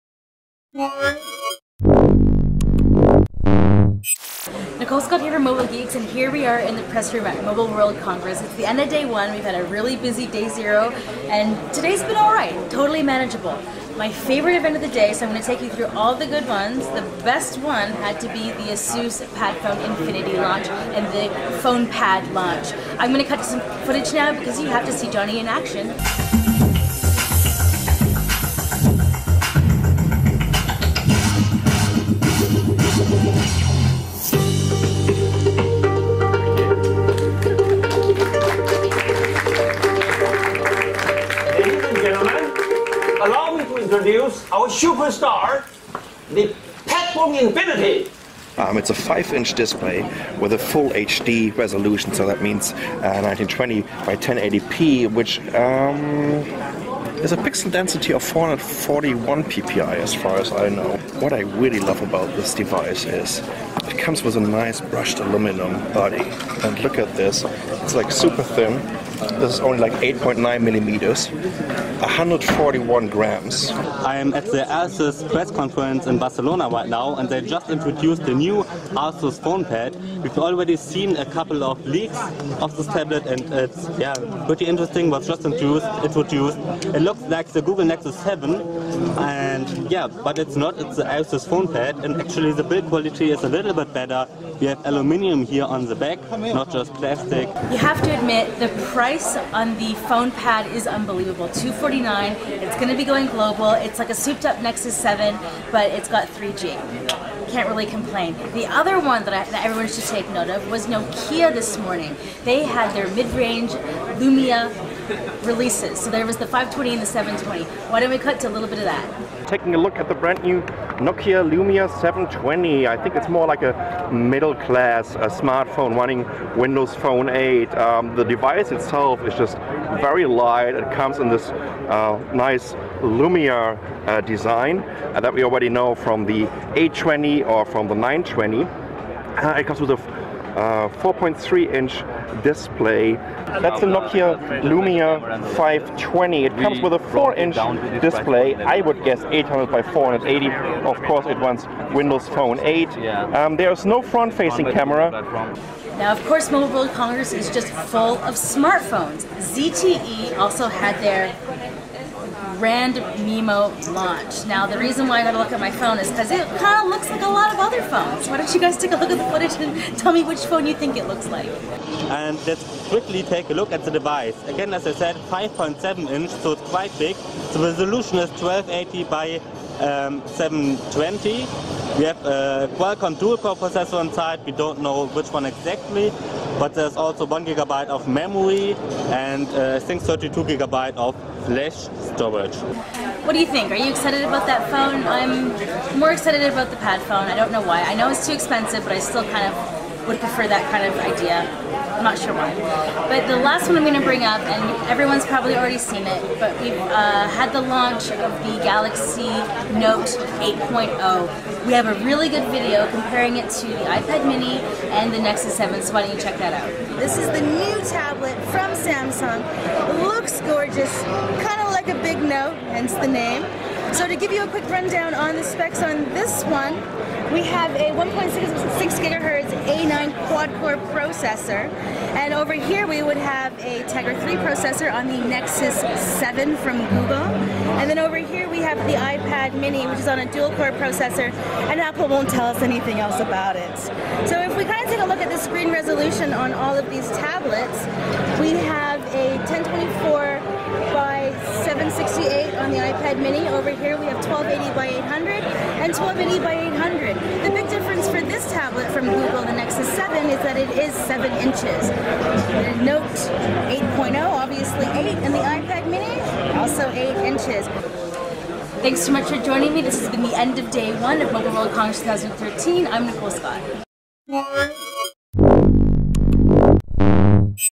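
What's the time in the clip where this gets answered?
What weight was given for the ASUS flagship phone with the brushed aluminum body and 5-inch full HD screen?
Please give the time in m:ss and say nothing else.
1:11.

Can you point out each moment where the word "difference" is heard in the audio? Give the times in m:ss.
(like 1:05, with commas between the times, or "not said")
4:17.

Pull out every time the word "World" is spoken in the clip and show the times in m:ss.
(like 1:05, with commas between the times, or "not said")
0:07, 2:36, 4:31.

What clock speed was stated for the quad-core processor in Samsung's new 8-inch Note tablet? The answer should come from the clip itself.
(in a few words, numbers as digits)
1.6 gigahertz.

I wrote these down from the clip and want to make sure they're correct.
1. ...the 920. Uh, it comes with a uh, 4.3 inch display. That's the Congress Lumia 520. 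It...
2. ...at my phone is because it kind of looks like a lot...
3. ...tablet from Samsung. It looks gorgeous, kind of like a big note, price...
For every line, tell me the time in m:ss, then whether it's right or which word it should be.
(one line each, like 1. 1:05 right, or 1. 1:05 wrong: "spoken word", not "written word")
1. 2:17 wrong: "Nokia", not "Congress"
2. 2:45 right
3. 3:37 wrong: "hence", not "price".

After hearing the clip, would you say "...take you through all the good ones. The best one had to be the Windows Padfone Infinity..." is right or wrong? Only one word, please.
wrong.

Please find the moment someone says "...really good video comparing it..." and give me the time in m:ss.
3:32.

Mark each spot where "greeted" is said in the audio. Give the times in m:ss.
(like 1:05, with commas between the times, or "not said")
not said.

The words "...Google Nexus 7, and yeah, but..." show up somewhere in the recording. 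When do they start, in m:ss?
1:27.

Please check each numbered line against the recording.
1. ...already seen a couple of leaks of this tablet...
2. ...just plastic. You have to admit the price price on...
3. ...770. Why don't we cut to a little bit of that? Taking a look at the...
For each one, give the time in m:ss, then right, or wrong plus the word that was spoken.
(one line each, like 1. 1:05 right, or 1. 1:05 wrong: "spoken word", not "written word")
1. 1:20 right
2. 1:36 right
3. 1:57 wrong: "720", not "770".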